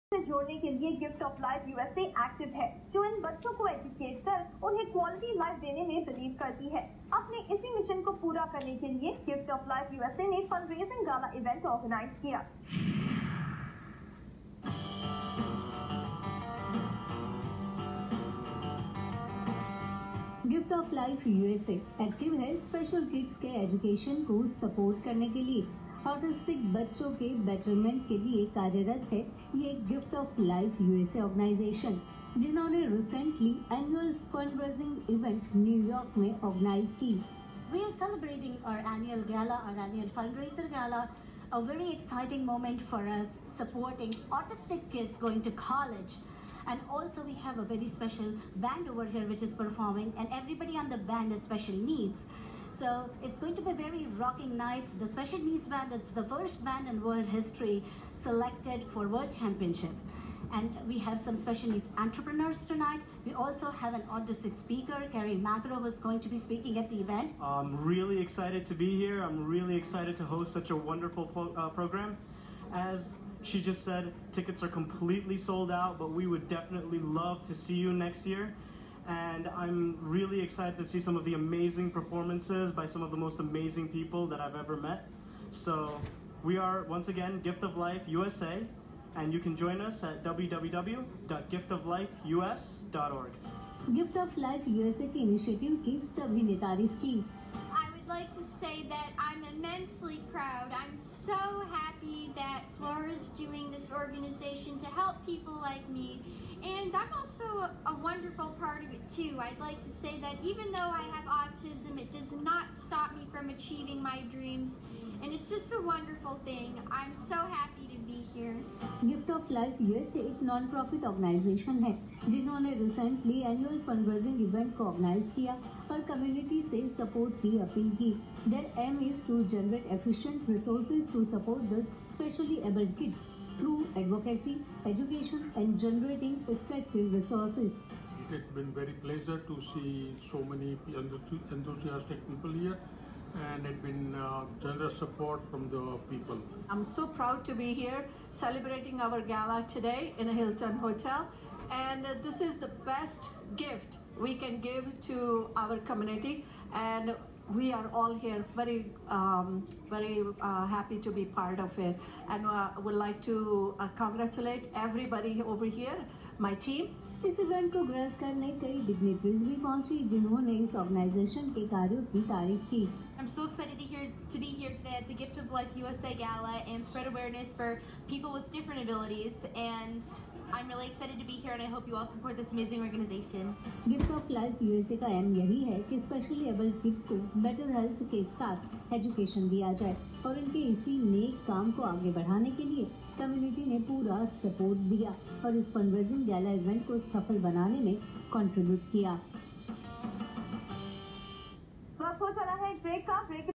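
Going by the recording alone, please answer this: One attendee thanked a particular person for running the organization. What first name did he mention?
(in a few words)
Flora.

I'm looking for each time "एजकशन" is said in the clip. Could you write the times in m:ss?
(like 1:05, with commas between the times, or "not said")
0:23, 3:08.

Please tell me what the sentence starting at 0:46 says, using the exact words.
And also we have a very special band over here which is performing and everybody on the band has special needs.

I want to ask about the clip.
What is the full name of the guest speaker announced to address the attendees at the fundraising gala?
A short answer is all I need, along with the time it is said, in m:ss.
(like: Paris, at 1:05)
Kerry Magro, at 1:05.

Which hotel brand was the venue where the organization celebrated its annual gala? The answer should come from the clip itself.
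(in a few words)
Hilton.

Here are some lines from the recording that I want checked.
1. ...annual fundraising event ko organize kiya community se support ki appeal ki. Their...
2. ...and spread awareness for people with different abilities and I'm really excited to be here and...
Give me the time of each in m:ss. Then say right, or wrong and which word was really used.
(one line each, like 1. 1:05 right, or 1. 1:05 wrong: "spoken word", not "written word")
1. 2:03 right
2. 2:56 right.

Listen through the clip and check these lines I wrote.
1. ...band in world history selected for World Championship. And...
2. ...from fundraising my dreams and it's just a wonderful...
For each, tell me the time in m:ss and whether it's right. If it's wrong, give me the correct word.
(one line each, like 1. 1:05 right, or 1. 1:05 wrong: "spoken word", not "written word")
1. 0:56 right
2. 1:53 wrong: "achieving", not "fundraising".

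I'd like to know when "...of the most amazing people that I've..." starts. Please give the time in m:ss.
1:23.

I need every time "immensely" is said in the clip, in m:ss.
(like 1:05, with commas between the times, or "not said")
1:39.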